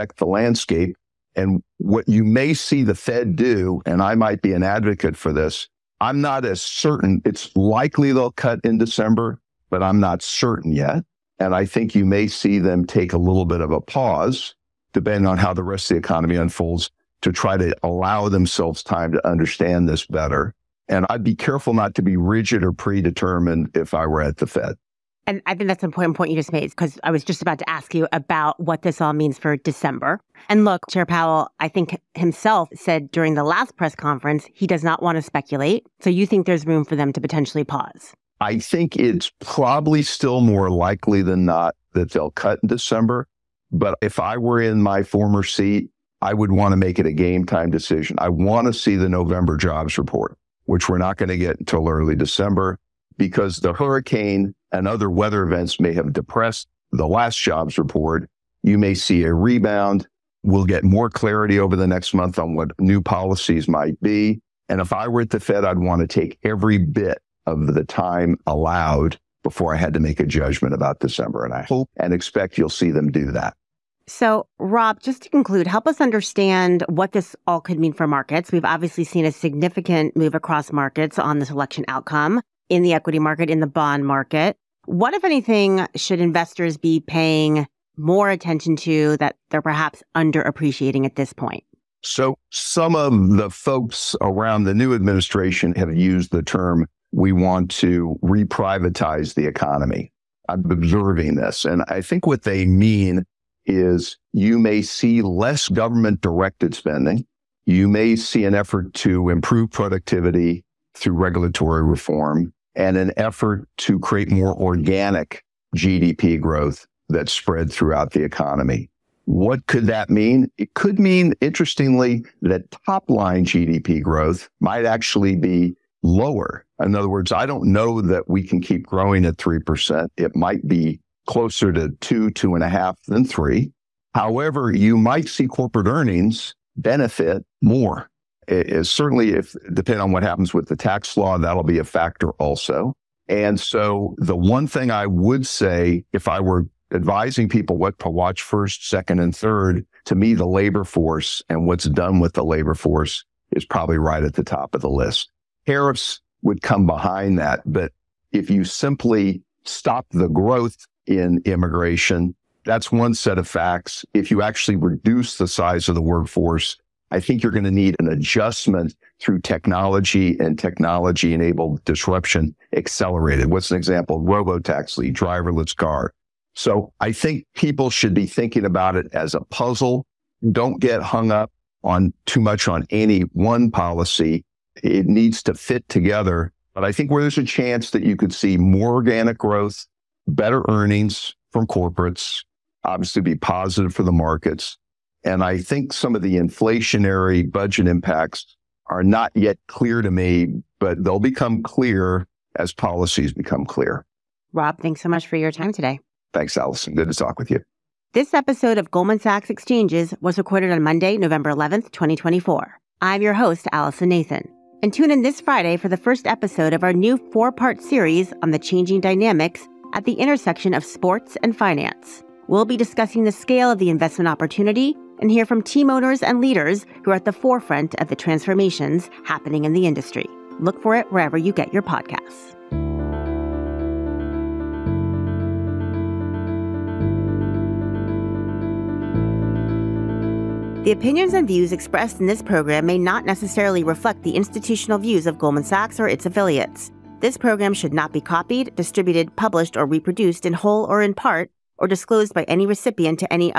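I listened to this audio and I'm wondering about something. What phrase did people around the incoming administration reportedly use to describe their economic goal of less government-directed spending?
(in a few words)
reprivatize the economy.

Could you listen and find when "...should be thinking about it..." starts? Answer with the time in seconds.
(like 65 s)
177 s.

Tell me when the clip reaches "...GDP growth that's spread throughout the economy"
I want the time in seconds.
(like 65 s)
115 s.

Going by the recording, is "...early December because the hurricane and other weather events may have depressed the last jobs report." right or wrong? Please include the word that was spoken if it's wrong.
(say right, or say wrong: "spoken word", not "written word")
right.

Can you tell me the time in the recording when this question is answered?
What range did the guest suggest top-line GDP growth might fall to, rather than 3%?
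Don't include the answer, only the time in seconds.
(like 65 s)
131 s.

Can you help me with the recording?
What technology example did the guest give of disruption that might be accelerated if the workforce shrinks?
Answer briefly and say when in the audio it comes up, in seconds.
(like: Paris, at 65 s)
Robotaxi, at 174 s.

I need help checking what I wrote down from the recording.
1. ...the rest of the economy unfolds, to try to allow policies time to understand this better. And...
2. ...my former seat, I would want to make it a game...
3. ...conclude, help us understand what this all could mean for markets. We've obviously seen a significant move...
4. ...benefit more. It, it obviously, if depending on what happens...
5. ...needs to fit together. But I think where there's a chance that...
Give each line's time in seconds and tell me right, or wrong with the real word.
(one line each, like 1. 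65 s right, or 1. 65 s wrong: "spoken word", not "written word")
1. 15 s wrong: "themselves", not "policies"
2. 44 s right
3. 75 s right
4. 136 s wrong: "certainly", not "obviously"
5. 185 s right.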